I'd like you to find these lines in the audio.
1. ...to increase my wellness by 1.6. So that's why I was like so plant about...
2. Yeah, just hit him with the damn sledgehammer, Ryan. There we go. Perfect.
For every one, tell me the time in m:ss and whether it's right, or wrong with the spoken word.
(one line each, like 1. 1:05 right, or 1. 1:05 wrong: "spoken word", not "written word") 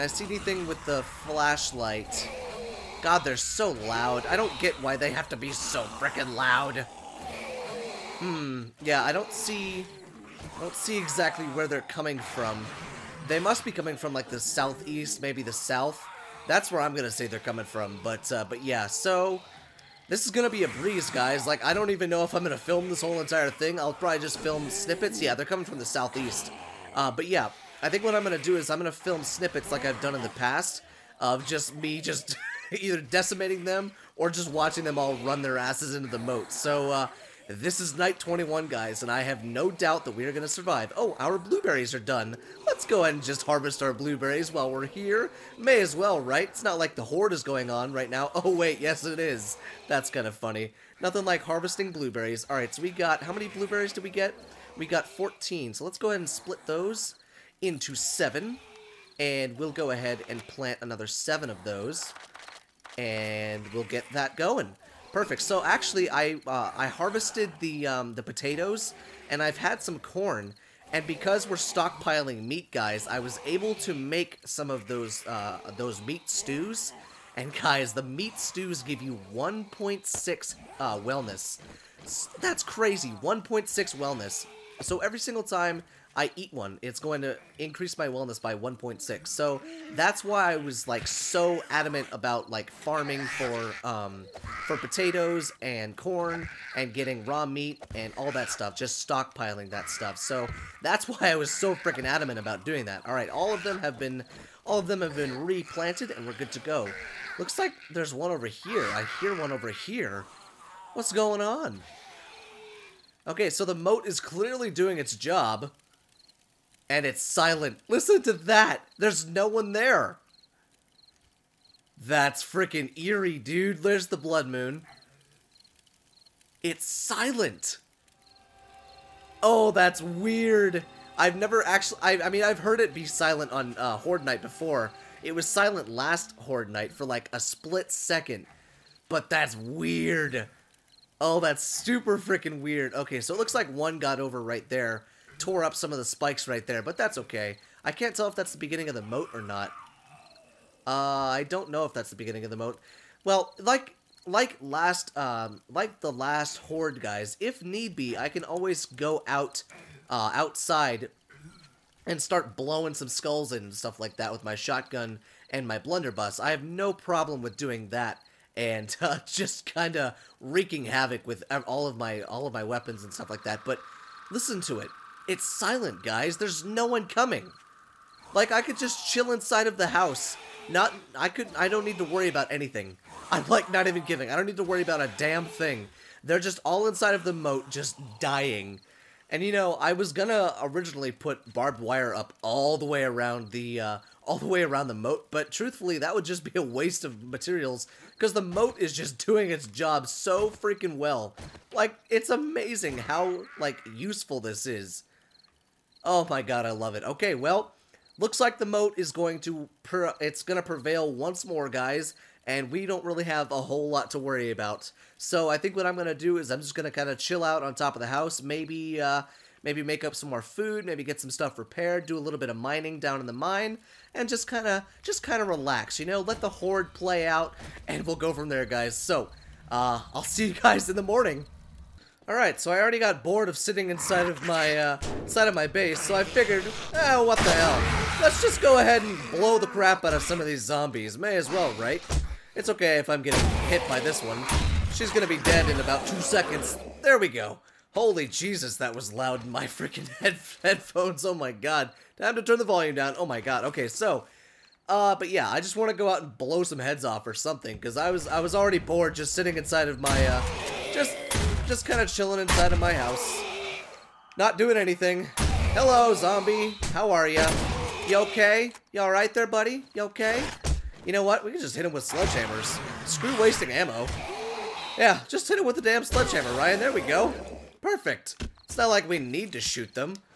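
1. 1:27 wrong: "adamant", not "plant"
2. 4:34 right.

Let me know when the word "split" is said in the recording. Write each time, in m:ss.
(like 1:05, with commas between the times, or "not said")
0:56, 2:17.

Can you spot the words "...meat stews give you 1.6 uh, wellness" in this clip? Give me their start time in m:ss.
1:18.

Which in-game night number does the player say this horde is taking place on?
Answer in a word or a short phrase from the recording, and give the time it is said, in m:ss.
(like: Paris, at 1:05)
21, at 0:37.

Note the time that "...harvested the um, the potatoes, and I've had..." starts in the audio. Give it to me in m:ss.
1:06.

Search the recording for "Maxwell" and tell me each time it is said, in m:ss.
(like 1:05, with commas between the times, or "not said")
not said.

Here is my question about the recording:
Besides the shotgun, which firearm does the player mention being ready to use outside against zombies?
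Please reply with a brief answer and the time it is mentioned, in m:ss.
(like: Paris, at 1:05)
blunderbuss, at 2:45.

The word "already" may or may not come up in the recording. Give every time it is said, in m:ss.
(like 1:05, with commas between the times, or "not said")
3:52, 4:18.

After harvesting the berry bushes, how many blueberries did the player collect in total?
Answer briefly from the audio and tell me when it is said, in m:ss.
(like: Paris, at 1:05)
14, at 0:55.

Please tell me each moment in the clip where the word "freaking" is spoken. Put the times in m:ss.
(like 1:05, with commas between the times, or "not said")
0:05, 1:41, 2:02, 2:22, 3:20, 4:09.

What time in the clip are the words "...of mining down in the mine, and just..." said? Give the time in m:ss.
3:42.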